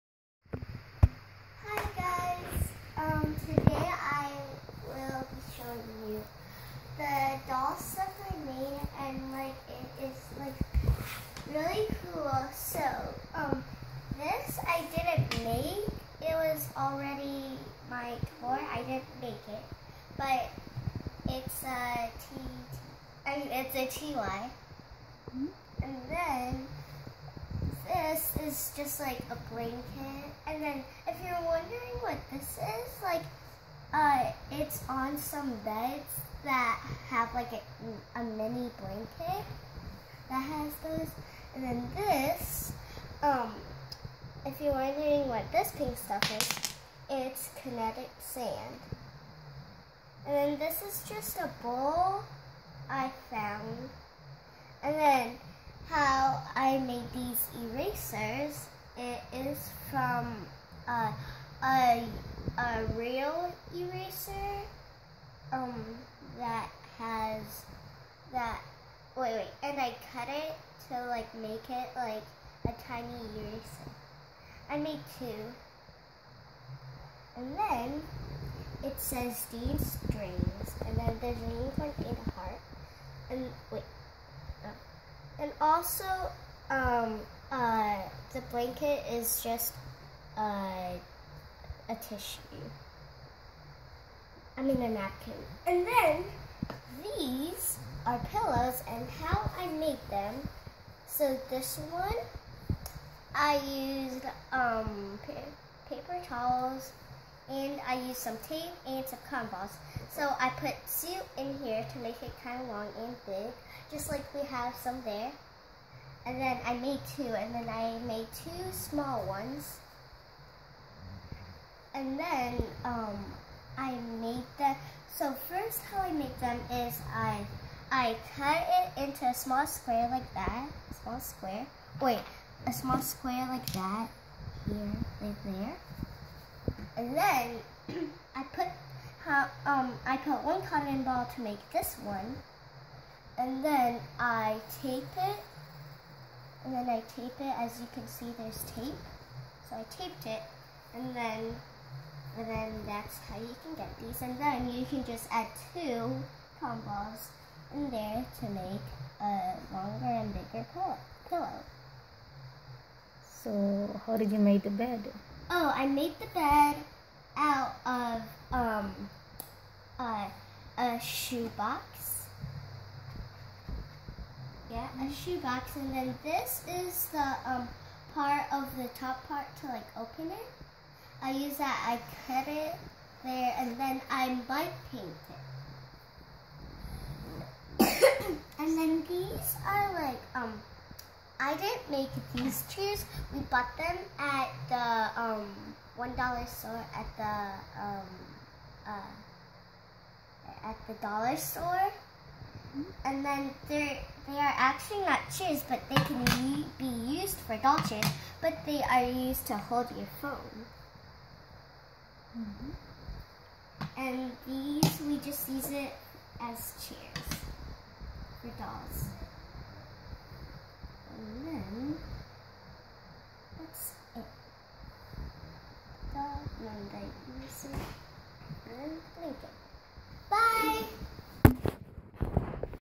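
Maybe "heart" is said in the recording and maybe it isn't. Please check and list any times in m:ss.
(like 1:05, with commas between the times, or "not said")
1:22.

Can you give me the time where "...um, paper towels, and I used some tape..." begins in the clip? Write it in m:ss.
1:44.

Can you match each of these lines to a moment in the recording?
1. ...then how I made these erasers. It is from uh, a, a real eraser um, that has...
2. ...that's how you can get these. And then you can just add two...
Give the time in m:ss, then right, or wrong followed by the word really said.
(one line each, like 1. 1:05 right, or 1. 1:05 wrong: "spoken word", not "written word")
1. 0:54 right
2. 2:32 right.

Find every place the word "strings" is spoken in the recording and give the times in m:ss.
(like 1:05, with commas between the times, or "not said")
1:20.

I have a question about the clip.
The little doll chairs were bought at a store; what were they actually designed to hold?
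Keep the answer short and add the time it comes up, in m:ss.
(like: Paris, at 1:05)
your phone, at 3:29.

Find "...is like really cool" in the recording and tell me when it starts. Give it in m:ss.
0:10.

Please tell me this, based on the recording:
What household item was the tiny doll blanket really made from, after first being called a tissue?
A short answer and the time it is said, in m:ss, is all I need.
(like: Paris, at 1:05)
a napkin, at 1:34.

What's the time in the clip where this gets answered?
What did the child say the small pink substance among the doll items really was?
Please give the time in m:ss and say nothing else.
0:47.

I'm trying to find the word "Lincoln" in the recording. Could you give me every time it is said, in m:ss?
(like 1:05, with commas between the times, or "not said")
3:49.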